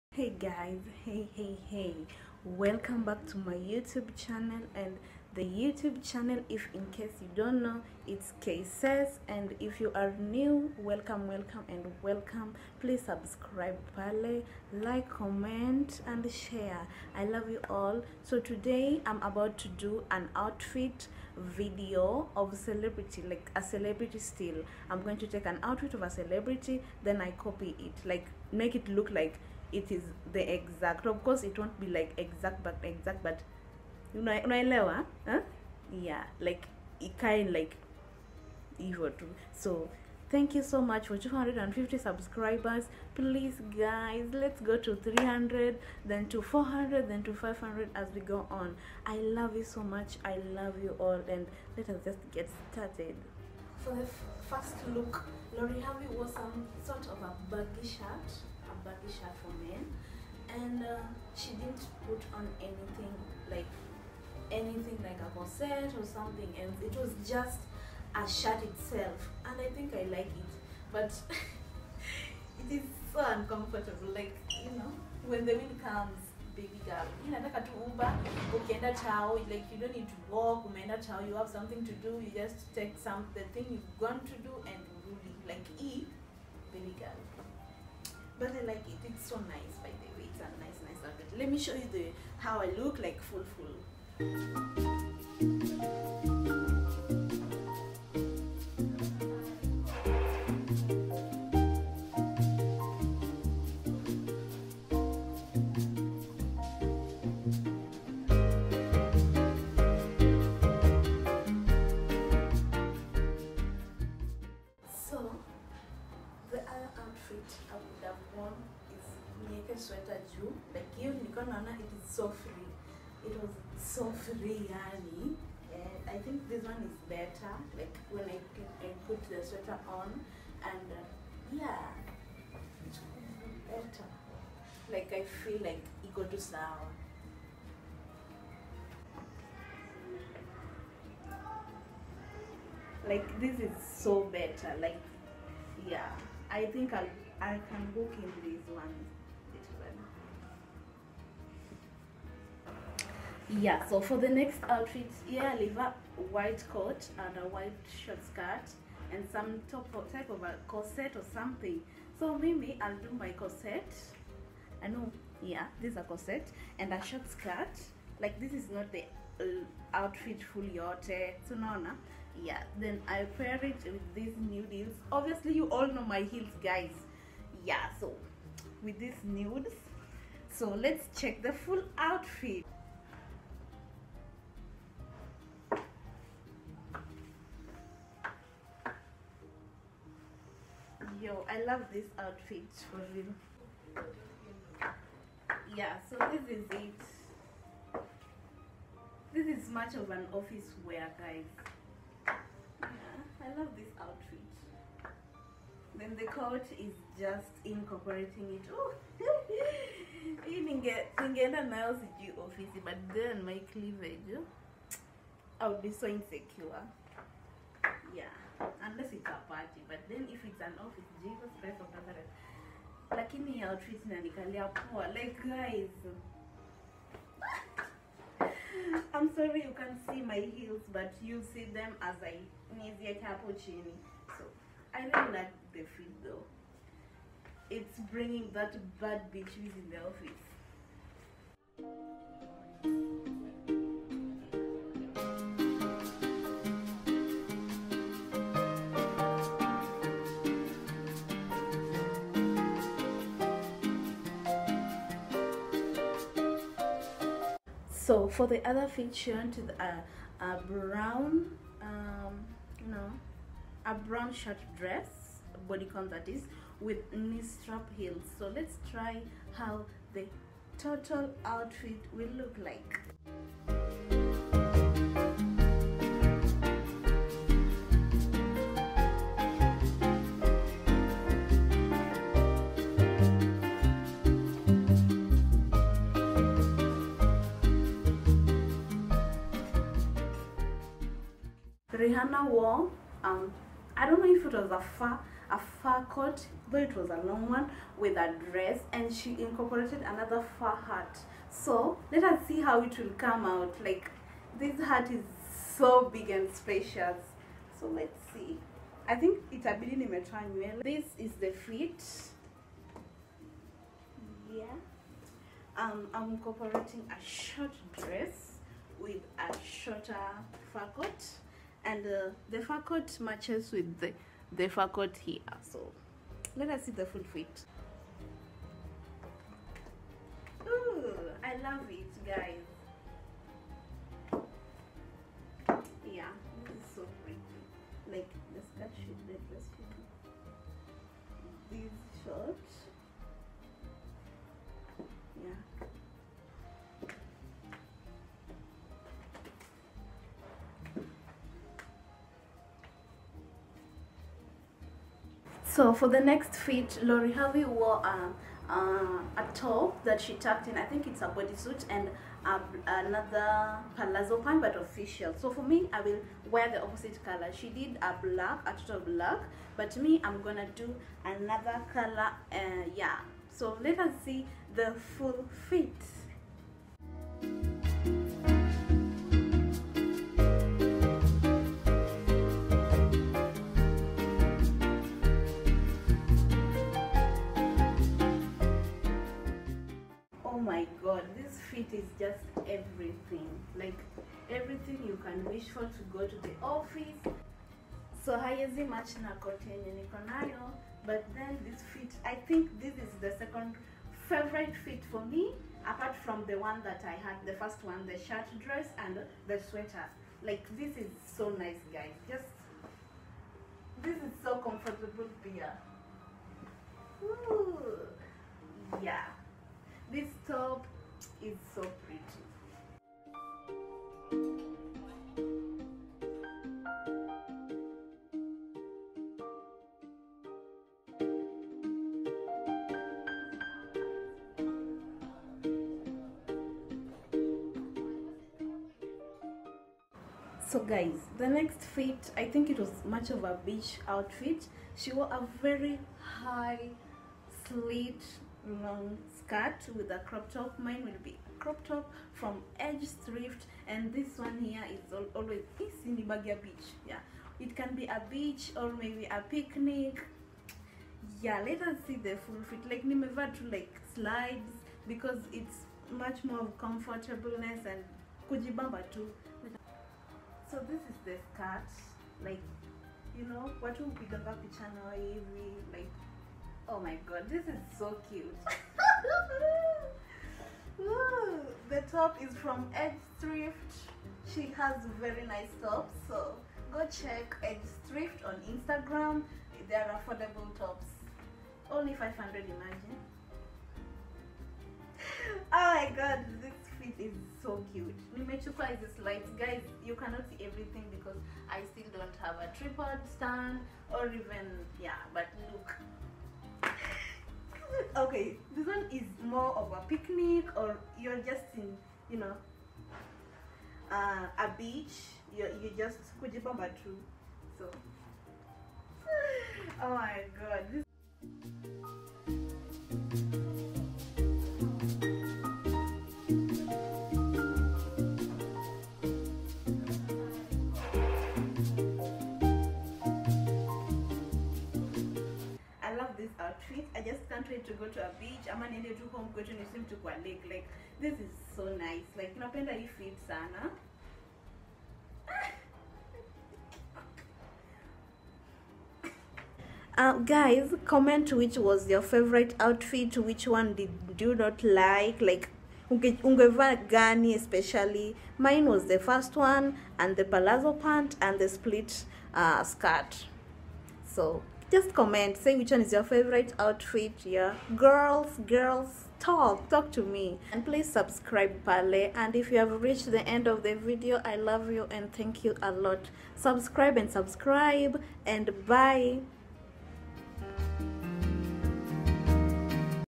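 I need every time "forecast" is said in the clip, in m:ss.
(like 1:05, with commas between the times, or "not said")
not said.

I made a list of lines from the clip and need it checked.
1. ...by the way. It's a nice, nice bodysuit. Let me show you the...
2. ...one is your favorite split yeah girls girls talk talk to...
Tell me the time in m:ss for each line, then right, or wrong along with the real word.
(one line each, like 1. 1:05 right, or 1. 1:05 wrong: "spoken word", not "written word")
1. 1:29 wrong: "outfit", not "bodysuit"
2. 9:25 wrong: "outfit", not "split".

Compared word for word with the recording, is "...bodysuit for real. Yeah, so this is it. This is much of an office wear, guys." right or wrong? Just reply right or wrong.
wrong.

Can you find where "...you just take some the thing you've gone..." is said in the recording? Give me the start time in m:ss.
1:22.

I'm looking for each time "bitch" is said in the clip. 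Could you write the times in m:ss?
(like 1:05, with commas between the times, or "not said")
3:59.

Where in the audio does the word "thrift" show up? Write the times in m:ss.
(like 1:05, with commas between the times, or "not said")
7:33, 8:03, 8:08.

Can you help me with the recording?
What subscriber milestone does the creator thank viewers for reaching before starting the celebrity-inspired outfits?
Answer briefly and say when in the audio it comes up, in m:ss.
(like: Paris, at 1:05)
250, at 0:41.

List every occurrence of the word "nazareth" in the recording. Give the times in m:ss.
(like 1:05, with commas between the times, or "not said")
3:41.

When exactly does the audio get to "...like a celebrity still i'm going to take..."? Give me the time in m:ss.
0:23.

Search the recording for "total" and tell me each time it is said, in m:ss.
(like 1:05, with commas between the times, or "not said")
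4:30, 6:08.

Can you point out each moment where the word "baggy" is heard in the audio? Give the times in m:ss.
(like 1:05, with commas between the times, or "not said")
0:57.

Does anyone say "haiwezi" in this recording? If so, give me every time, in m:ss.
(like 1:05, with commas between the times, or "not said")
6:38.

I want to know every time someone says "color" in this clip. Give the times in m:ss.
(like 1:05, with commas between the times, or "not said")
6:07, 6:11.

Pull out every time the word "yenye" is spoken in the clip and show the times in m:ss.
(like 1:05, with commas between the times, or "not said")
6:39.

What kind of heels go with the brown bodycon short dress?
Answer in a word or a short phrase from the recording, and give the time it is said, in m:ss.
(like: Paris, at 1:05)
Knee strap heels, at 4:27.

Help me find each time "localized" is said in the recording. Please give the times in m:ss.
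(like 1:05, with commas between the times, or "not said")
not said.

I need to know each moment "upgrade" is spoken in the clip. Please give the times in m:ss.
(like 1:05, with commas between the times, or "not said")
not said.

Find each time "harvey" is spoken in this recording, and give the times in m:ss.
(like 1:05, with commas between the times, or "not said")
0:55, 5:57.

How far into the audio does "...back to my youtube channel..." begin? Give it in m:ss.
0:03.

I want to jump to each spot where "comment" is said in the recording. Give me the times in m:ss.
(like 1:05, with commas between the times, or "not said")
0:15, 9:11, 9:25.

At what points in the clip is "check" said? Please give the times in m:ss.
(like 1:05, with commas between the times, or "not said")
3:01, 8:07.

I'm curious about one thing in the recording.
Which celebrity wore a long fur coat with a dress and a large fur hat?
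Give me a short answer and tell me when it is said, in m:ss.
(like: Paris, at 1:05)
Rihanna, at 4:51.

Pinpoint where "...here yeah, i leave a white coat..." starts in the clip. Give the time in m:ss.
2:35.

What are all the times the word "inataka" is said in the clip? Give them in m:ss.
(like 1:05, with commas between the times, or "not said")
1:17.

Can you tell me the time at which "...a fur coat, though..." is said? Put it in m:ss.
4:55.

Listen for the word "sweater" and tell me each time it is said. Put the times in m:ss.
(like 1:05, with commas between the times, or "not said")
2:09, 6:49.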